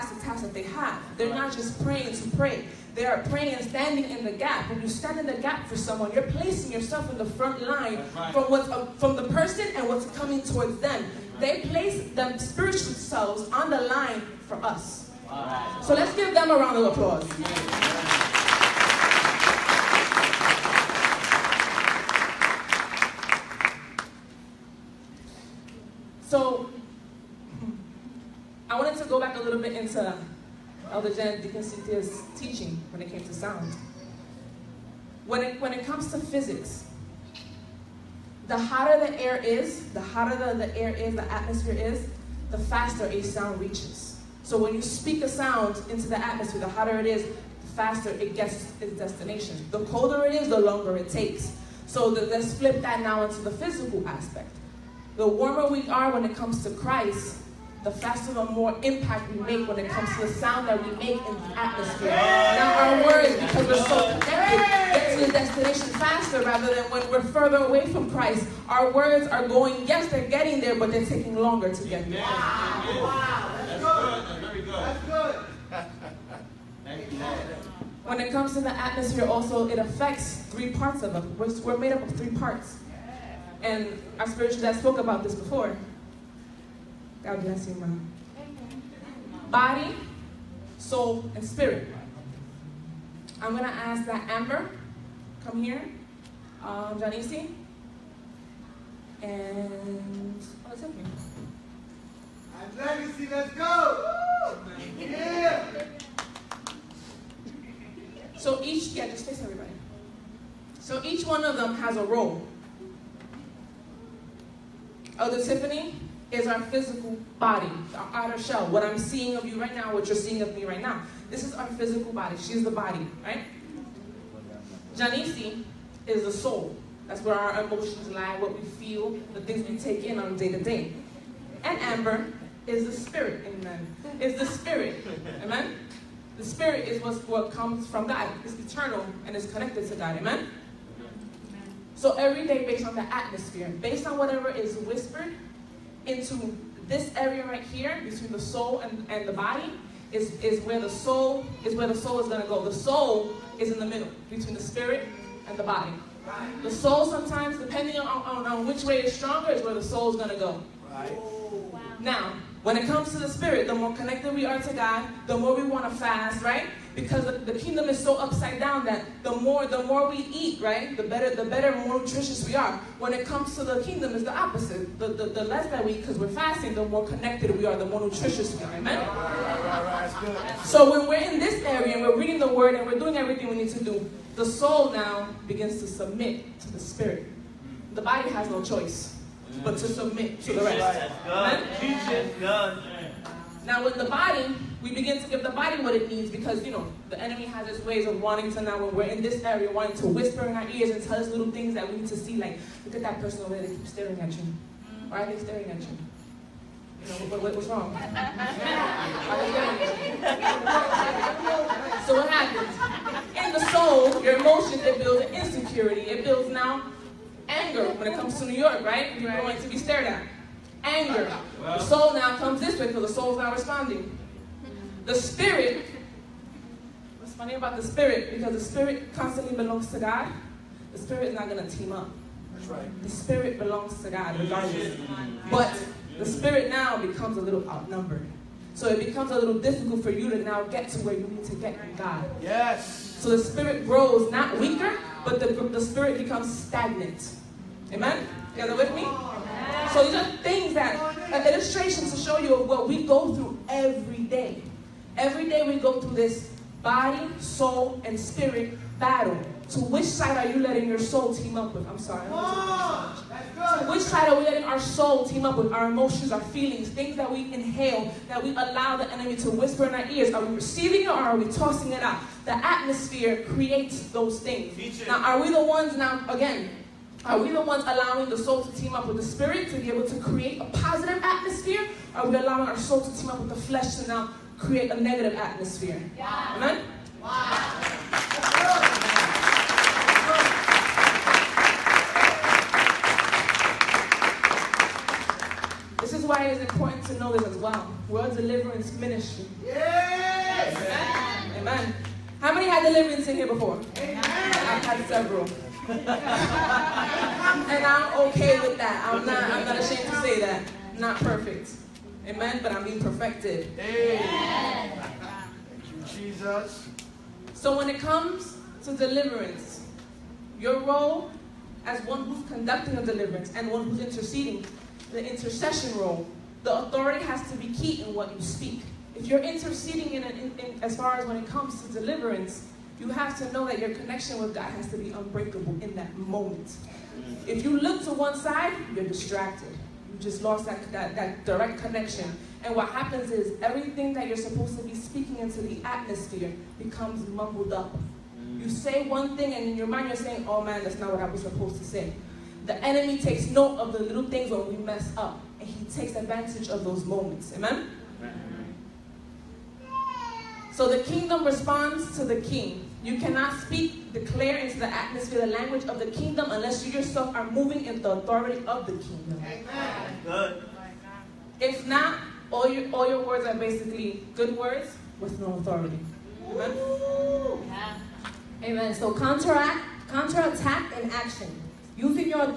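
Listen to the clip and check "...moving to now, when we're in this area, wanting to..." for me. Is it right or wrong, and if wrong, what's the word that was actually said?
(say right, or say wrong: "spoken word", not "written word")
wrong: "wanting", not "moving".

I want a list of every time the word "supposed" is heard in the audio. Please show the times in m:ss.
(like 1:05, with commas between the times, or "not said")
5:44, 5:51.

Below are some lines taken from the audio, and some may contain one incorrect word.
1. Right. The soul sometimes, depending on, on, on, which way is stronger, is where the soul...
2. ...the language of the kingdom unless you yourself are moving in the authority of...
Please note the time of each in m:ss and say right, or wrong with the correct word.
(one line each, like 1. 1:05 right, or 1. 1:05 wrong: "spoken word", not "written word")
1. 2:36 right
2. 6:05 right.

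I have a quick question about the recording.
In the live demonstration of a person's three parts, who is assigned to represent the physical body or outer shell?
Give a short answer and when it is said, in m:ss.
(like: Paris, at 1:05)
Elder Tiffany, at 1:55.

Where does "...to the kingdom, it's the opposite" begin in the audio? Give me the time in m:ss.
2:53.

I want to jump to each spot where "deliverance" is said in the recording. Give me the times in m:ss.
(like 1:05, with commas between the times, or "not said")
4:58, 5:02, 5:18, 5:23, 5:31.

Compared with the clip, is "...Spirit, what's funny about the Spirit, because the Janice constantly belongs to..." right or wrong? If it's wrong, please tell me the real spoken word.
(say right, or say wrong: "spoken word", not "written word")
wrong: "Spirit", not "Janice".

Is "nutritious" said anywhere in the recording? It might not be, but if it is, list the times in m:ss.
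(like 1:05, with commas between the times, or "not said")
2:51, 2:58.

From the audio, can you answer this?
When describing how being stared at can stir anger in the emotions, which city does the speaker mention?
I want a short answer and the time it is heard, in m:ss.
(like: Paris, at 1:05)
New York, at 3:38.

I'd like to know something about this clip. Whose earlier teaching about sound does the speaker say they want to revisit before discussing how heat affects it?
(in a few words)
Elder Janet DeConcitia.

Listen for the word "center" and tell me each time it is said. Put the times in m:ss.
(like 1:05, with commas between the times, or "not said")
not said.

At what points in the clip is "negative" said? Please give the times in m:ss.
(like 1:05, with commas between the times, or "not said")
4:44.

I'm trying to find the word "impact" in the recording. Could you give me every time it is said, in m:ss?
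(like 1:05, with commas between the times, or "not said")
0:58.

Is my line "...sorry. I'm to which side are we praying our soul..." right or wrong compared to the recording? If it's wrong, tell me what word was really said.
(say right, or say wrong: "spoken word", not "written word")
wrong: "letting", not "praying".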